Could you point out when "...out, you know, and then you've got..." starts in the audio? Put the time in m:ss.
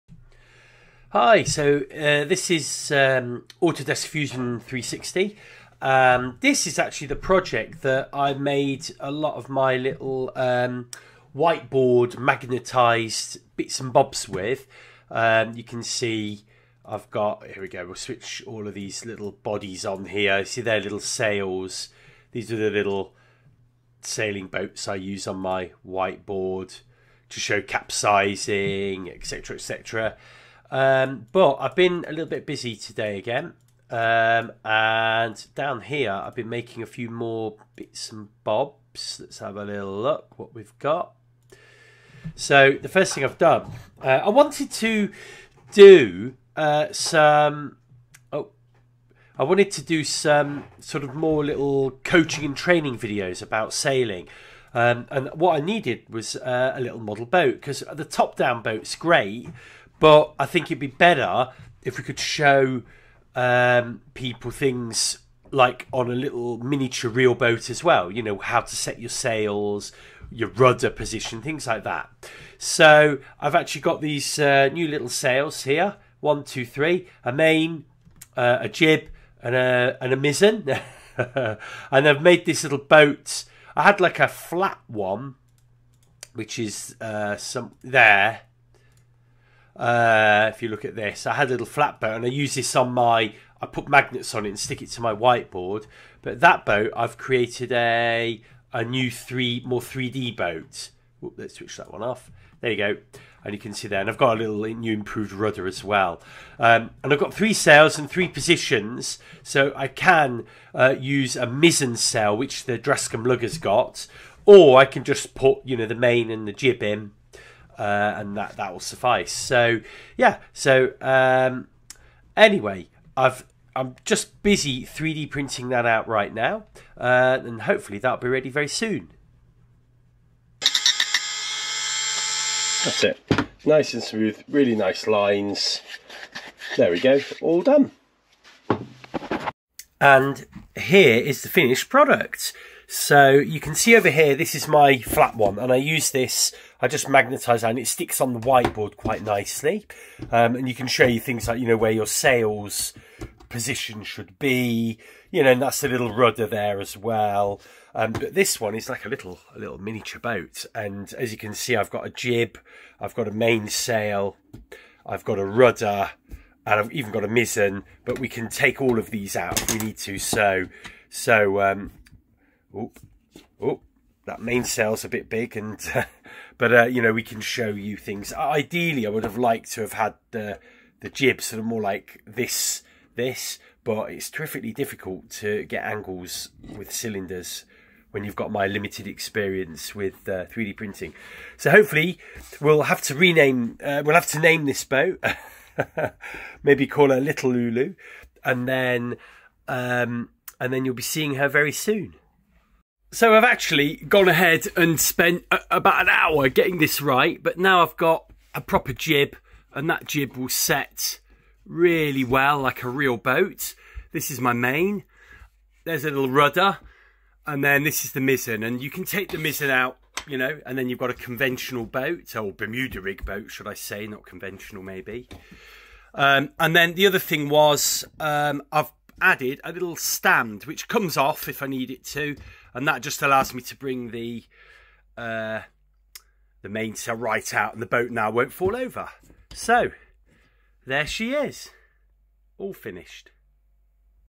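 3:39.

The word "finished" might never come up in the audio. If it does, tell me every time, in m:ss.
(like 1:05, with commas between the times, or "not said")
2:21, 4:02.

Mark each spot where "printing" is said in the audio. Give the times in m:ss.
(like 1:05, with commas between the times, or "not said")
2:05, 3:10.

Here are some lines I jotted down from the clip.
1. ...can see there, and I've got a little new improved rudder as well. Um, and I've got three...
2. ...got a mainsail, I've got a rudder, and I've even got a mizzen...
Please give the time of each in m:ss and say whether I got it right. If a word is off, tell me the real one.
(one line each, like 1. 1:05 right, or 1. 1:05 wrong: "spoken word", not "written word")
1. 1:43 right
2. 2:43 right.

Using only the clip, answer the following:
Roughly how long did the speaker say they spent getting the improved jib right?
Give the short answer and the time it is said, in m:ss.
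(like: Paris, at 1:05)
about an hour, at 3:25.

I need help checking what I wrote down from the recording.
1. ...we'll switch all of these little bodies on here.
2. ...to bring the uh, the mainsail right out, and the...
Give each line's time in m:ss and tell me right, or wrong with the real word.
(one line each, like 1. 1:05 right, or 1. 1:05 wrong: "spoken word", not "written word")
1. 0:17 right
2. 3:53 right.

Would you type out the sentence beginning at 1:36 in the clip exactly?
But that boat, I've created a a new three, more 3D boat.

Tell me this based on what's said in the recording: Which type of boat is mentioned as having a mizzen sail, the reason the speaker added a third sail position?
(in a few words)
Drascombe lugger.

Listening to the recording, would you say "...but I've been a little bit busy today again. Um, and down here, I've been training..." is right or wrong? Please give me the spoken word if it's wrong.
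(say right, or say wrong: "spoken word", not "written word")
wrong: "making", not "training".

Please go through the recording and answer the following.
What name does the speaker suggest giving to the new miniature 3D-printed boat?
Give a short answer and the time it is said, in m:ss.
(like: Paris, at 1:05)
Little Lulu, at 3:17.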